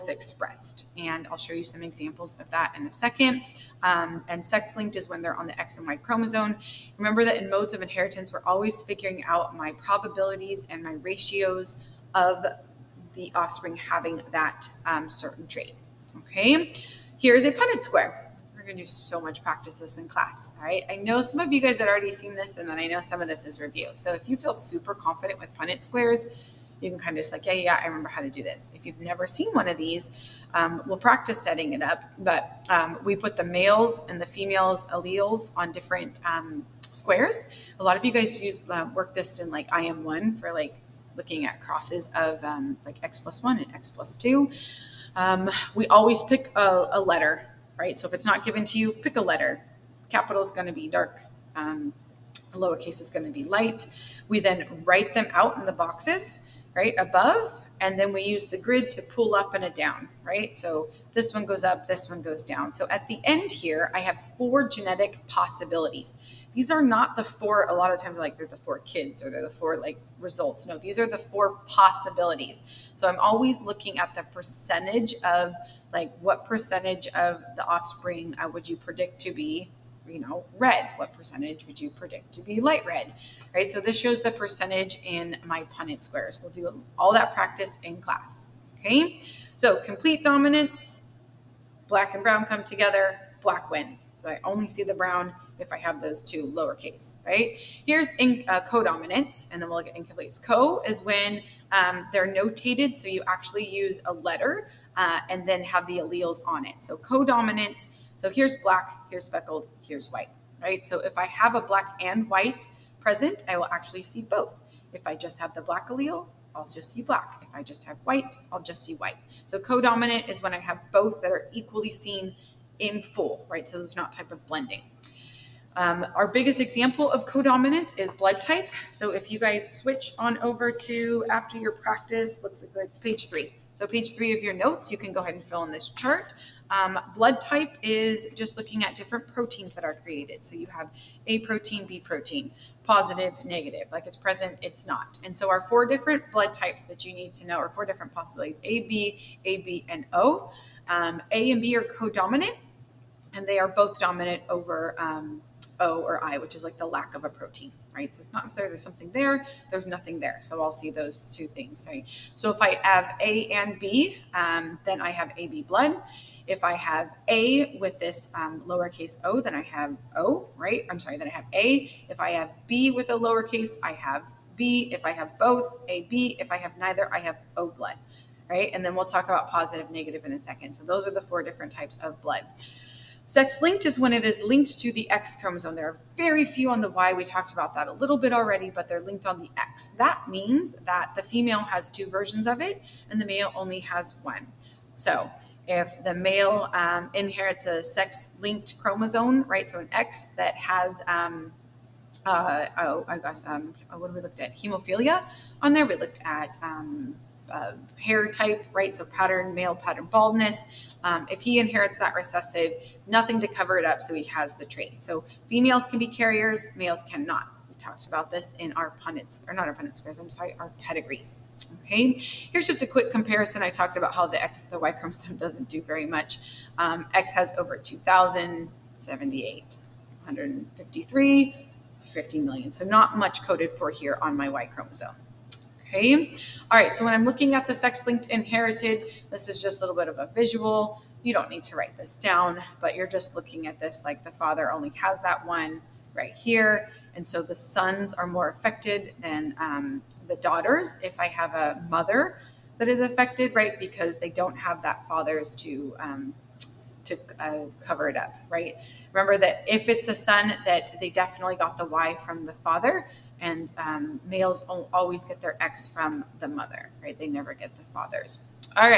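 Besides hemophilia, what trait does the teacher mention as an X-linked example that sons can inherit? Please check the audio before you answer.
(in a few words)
Male pattern baldness.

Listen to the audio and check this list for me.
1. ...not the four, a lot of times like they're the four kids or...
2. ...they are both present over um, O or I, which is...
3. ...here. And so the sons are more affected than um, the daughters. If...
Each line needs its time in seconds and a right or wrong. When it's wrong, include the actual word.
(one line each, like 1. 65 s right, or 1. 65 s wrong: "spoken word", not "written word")
1. 66 s right
2. 153 s wrong: "dominant", not "present"
3. 246 s right.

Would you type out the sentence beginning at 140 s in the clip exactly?
So you have A protein, B protein, positive, negative, like it's present, it's not.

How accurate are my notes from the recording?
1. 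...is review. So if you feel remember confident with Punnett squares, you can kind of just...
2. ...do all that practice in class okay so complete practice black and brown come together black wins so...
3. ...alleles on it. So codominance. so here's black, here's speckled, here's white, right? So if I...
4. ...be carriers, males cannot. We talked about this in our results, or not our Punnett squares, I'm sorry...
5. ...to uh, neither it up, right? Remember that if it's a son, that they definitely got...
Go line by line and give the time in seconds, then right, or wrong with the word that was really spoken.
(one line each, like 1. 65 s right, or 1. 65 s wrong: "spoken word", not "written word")
1. 23 s wrong: "super", not "remember"
2. 86 s wrong: "dominance", not "practice"
3. 105 s right
4. 215 s wrong: "punnets", not "results"
5. 257 s wrong: "cover", not "neither".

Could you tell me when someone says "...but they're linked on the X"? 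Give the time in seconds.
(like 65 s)
188 s.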